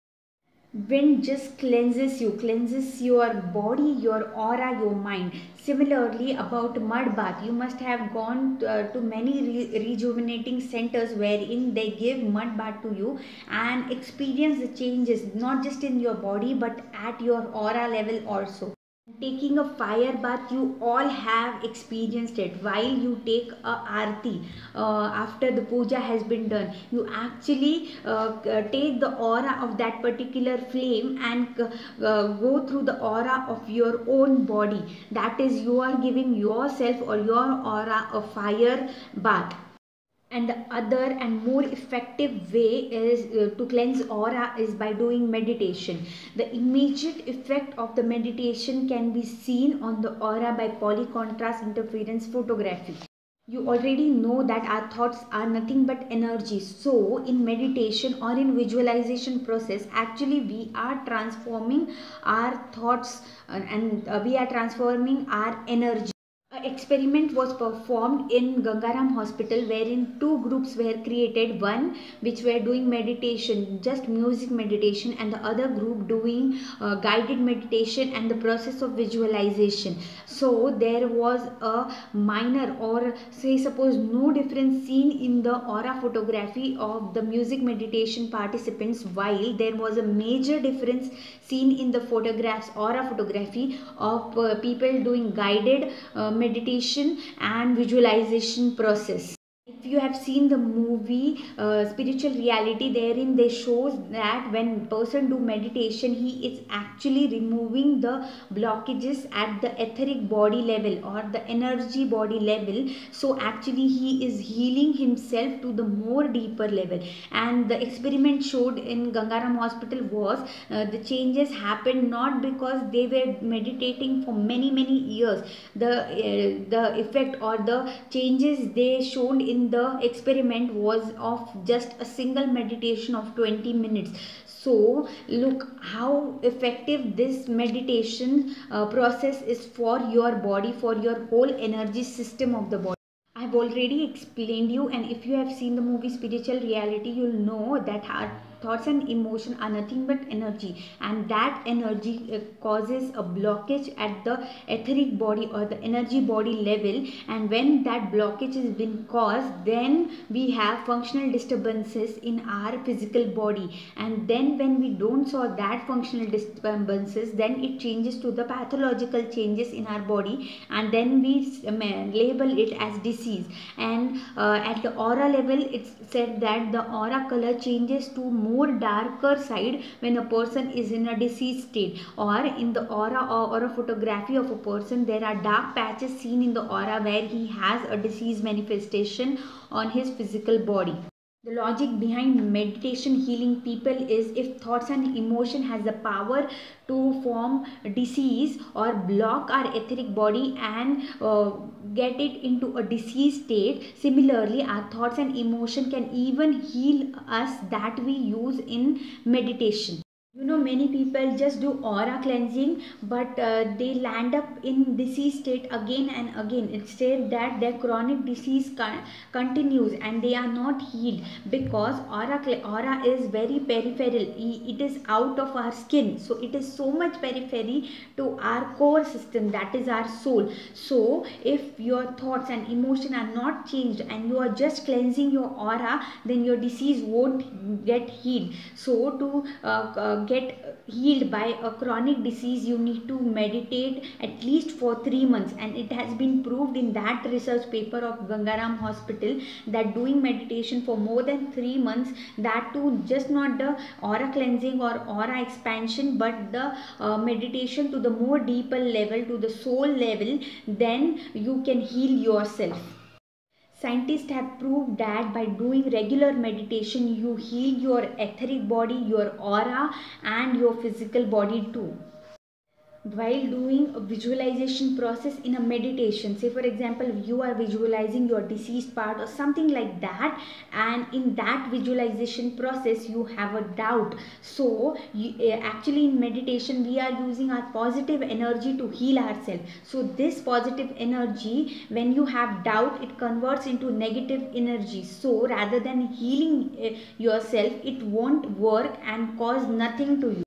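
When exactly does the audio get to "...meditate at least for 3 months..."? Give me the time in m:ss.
4:03.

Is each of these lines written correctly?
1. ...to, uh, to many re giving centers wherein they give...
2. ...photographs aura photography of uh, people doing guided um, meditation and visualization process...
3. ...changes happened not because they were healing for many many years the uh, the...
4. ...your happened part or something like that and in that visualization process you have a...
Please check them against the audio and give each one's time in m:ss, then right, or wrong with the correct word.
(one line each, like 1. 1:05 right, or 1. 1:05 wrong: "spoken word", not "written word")
1. 0:08 wrong: "rejuvenating", not "giving"
2. 1:32 right
3. 2:01 wrong: "meditating", not "healing"
4. 4:38 wrong: "deceased", not "happened".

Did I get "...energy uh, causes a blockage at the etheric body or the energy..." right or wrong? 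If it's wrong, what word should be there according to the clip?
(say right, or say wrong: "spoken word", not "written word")
right.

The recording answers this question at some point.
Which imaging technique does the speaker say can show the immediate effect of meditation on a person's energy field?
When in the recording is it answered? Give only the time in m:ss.
0:50.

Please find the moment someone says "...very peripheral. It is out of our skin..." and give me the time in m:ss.
3:43.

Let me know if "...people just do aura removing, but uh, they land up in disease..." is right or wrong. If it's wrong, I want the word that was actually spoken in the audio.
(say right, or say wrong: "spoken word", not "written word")
wrong: "cleansing", not "removing".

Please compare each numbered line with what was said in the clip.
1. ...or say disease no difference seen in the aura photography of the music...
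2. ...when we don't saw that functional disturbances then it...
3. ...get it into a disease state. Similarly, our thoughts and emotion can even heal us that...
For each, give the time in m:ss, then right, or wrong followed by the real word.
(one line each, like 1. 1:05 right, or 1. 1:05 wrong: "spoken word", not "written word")
1. 1:22 wrong: "suppose", not "disease"
2. 2:44 right
3. 3:21 right.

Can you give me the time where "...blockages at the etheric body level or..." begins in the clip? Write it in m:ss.
1:48.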